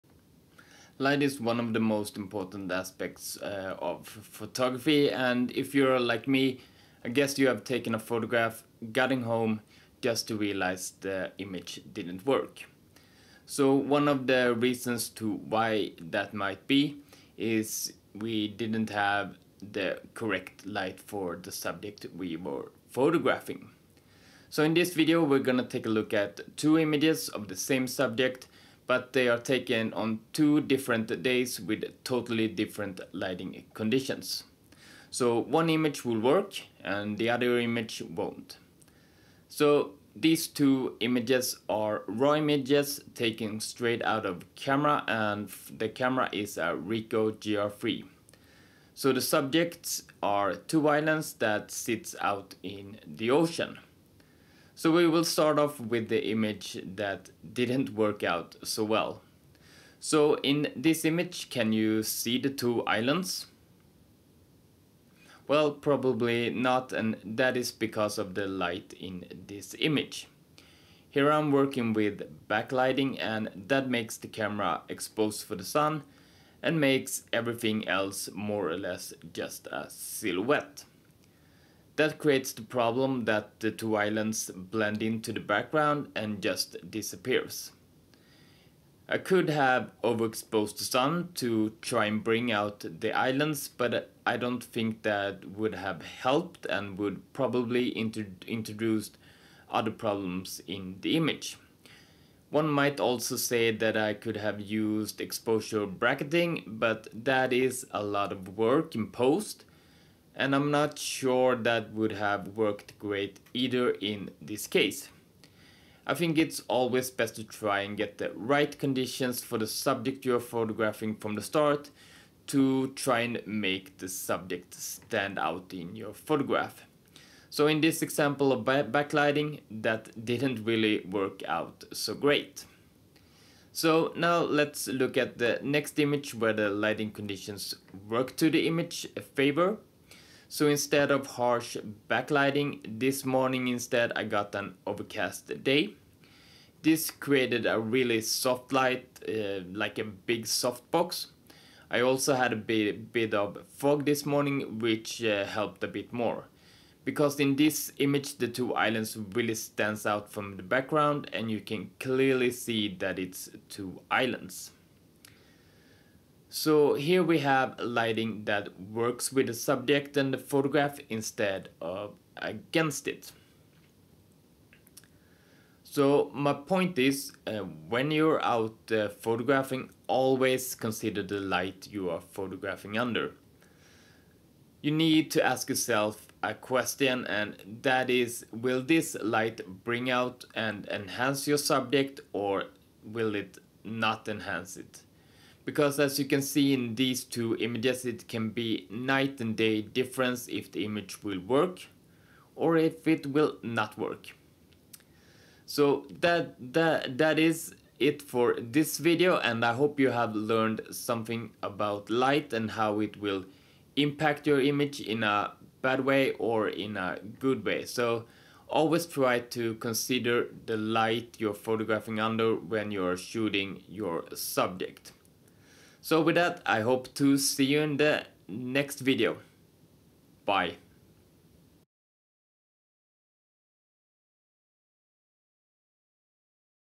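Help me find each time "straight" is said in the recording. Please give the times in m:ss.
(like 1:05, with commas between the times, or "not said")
0:43.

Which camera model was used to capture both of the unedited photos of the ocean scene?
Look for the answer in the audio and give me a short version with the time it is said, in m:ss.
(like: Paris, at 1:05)
Ricoh GR3, at 0:46.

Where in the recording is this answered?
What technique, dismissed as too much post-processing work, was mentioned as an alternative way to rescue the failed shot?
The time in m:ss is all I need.
1:45.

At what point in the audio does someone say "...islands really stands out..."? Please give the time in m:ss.
2:38.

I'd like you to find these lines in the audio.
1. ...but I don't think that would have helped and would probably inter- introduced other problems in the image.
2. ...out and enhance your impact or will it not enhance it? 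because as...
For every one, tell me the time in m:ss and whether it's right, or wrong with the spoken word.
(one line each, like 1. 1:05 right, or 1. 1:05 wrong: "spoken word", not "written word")
1. 1:33 right
2. 3:10 wrong: "subject", not "impact".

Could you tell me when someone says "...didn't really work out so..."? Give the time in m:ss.
2:10.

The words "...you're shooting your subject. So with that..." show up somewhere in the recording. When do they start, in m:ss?
3:42.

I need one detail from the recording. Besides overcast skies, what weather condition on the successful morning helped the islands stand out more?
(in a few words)
Fog.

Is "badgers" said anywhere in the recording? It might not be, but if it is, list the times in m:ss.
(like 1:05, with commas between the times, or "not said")
not said.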